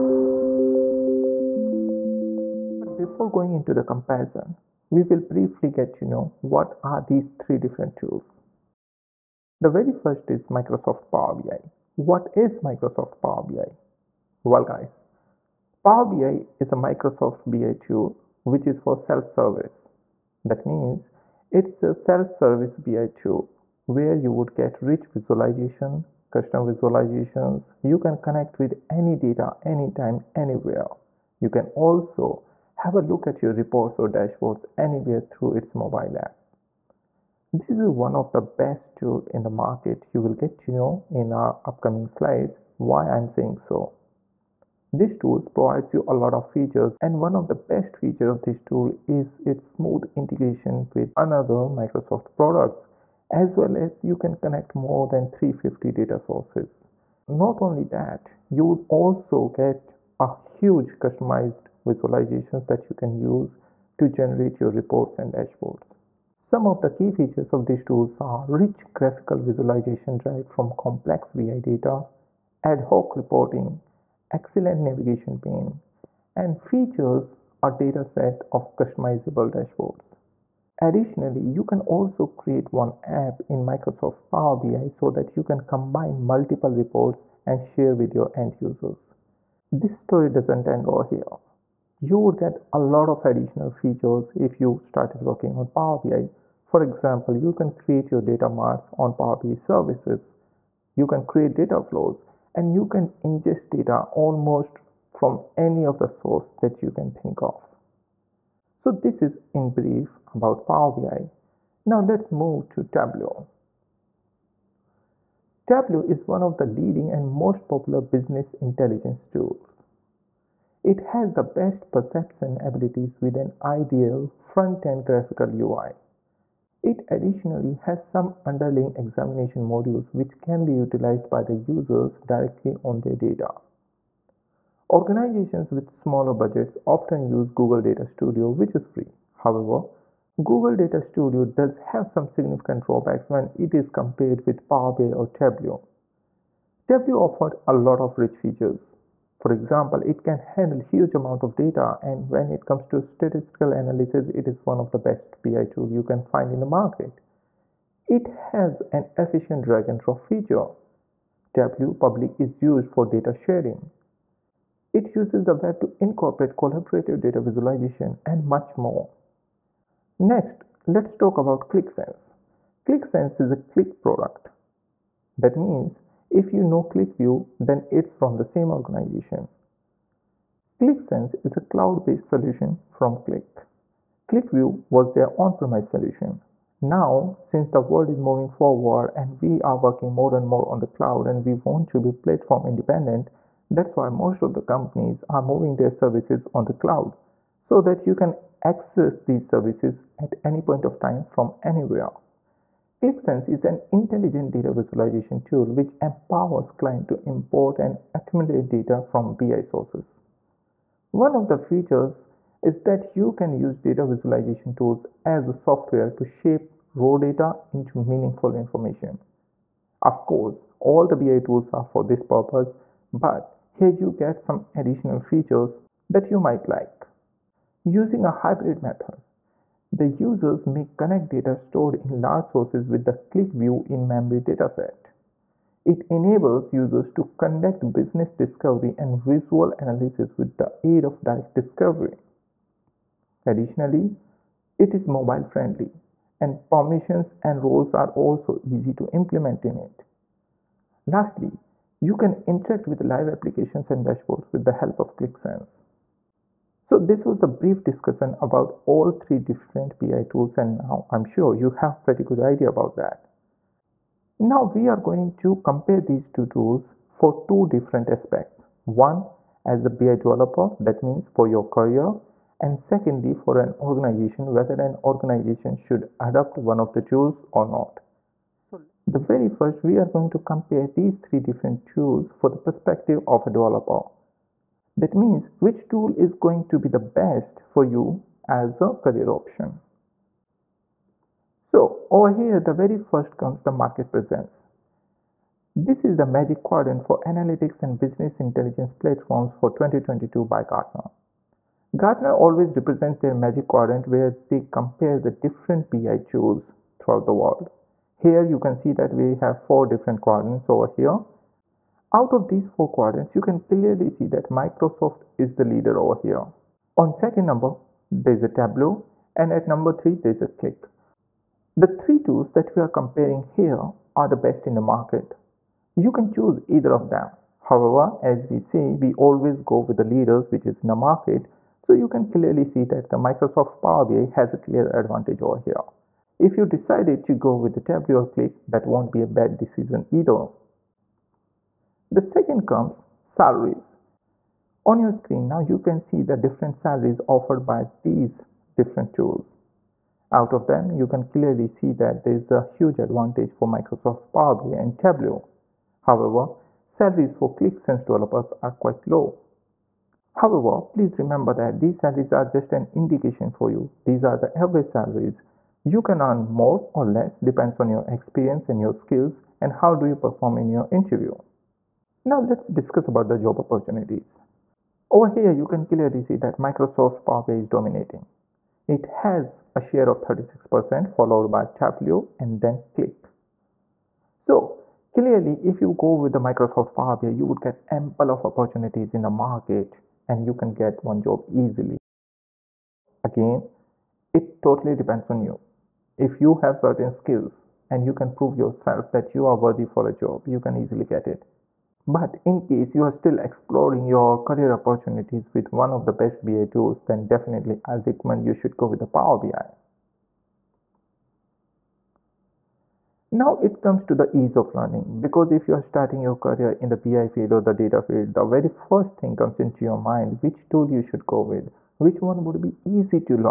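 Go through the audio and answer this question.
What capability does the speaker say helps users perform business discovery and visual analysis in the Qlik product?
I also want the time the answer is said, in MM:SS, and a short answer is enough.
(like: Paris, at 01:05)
direct discovery, at 04:01.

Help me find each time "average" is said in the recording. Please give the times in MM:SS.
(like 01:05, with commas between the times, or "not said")
06:04.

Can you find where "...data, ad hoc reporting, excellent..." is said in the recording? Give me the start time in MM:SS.
01:11.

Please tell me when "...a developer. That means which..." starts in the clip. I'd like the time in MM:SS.
04:43.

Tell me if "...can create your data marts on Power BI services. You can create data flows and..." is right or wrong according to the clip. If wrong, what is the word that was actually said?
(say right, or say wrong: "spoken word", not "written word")
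right.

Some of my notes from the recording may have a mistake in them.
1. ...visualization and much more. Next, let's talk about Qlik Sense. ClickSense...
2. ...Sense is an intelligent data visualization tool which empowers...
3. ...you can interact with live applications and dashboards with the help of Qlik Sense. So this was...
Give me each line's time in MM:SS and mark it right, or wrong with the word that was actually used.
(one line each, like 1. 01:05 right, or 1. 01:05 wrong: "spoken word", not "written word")
1. 02:47 right
2. 03:23 right
3. 04:11 right.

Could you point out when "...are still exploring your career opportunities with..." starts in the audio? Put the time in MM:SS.
06:43.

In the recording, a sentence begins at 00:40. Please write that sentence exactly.
You will get to know in our upcoming slides why I'm saying so.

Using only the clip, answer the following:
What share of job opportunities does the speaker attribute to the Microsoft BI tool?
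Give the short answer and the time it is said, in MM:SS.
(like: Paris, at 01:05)
36%, at 06:20.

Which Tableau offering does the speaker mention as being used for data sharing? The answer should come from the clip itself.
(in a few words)
Tableau Public.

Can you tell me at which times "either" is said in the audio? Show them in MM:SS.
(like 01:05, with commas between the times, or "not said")
05:26, 05:40.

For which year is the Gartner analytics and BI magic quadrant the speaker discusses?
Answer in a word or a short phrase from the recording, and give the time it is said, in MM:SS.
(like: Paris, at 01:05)
2022, at 04:59.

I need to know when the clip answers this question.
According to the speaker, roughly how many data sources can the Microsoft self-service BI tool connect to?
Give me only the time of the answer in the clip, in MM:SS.
00:55.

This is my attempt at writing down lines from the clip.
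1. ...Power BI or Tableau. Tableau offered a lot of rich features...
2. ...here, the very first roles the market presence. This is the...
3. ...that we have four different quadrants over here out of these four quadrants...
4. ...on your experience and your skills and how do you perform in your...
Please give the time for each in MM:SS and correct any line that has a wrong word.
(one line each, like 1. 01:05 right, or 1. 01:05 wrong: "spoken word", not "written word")
1. 02:24 right
2. 04:52 wrong: "comes", not "roles"
3. 05:08 right
4. 06:07 right.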